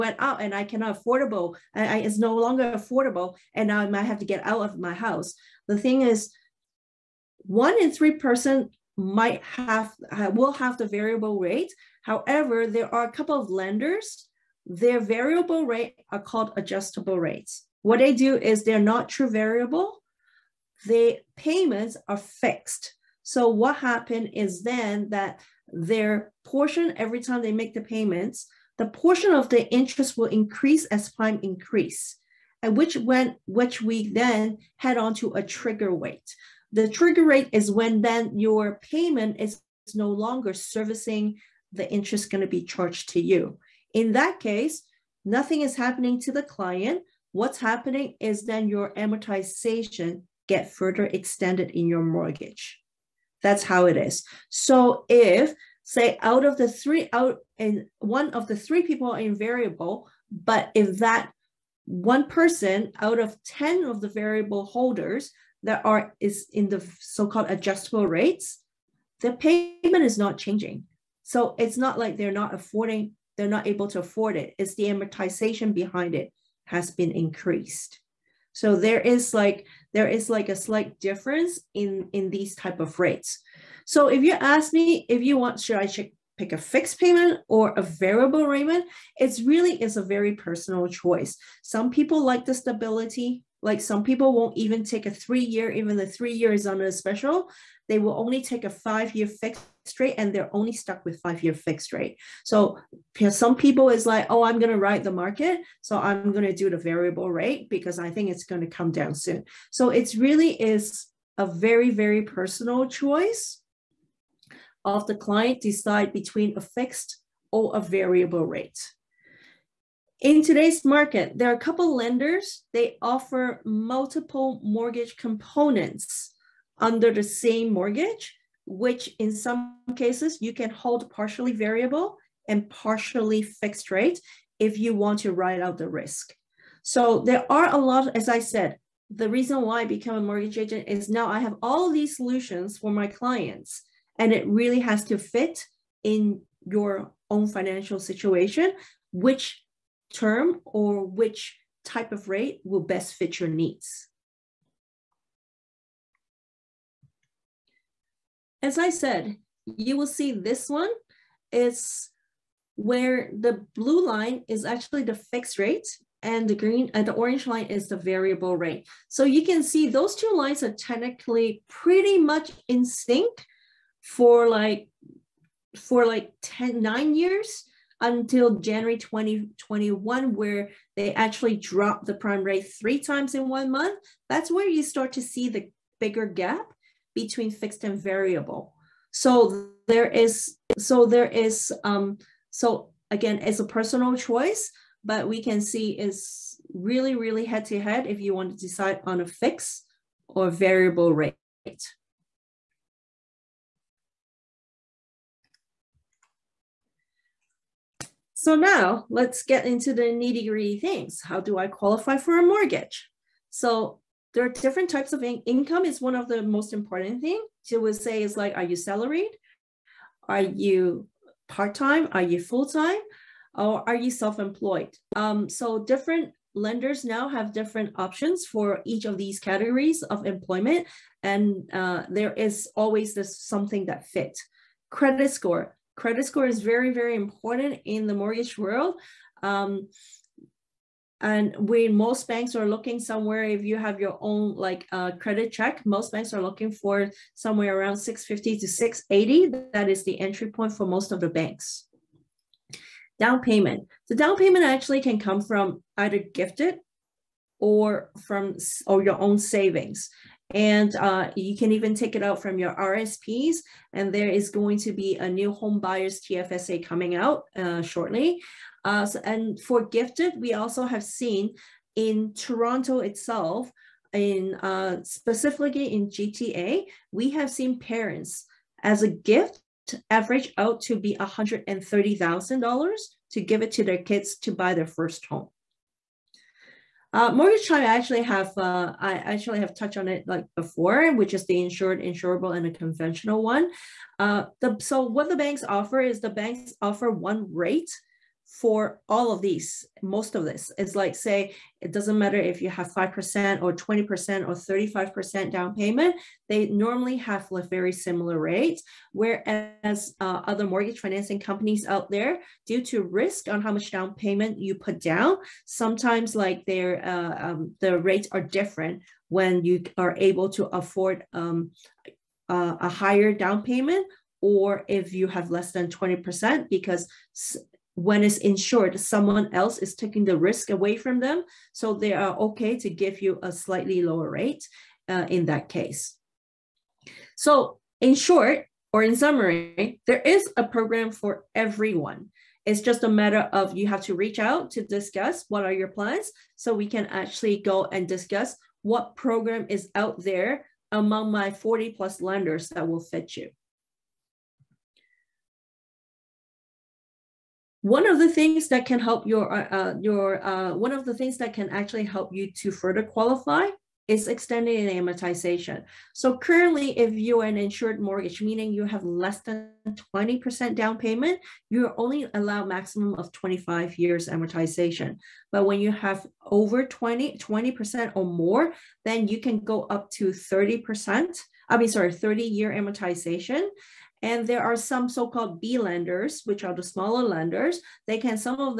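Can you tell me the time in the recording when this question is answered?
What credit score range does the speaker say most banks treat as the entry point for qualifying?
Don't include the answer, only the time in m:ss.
4:07.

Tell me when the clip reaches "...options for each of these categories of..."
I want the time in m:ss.
3:47.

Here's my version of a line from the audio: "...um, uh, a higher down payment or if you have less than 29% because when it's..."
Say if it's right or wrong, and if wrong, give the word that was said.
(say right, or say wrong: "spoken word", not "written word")
wrong: "20", not "29".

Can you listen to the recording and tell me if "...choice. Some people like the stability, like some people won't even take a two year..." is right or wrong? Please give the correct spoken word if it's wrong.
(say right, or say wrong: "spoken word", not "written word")
wrong: "three", not "two".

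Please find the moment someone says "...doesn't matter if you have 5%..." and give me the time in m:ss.
5:01.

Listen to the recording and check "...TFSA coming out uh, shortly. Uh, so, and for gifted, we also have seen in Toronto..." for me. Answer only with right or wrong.
right.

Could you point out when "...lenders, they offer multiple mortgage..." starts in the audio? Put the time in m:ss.
2:01.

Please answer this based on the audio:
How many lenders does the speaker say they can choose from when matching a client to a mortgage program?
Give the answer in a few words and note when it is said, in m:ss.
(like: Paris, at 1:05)
40 plus, at 5:51.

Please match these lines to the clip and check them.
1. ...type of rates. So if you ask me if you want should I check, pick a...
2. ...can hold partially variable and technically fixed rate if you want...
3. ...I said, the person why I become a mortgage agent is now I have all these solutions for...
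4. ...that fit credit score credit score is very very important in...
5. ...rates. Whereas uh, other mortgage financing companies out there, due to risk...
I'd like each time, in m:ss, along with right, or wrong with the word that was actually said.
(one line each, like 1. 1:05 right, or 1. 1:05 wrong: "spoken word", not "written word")
1. 1:22 right
2. 2:10 wrong: "partially", not "technically"
3. 2:18 wrong: "reason", not "person"
4. 3:53 right
5. 5:08 right.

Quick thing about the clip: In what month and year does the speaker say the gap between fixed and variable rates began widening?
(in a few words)
January 2021.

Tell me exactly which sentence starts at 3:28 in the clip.
So now let's get into the nitty gritty things.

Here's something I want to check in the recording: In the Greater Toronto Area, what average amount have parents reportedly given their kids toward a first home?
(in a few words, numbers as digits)
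$130,000.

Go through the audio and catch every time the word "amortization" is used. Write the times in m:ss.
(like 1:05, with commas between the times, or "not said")
0:48, 1:14, 6:05, 6:14, 6:22.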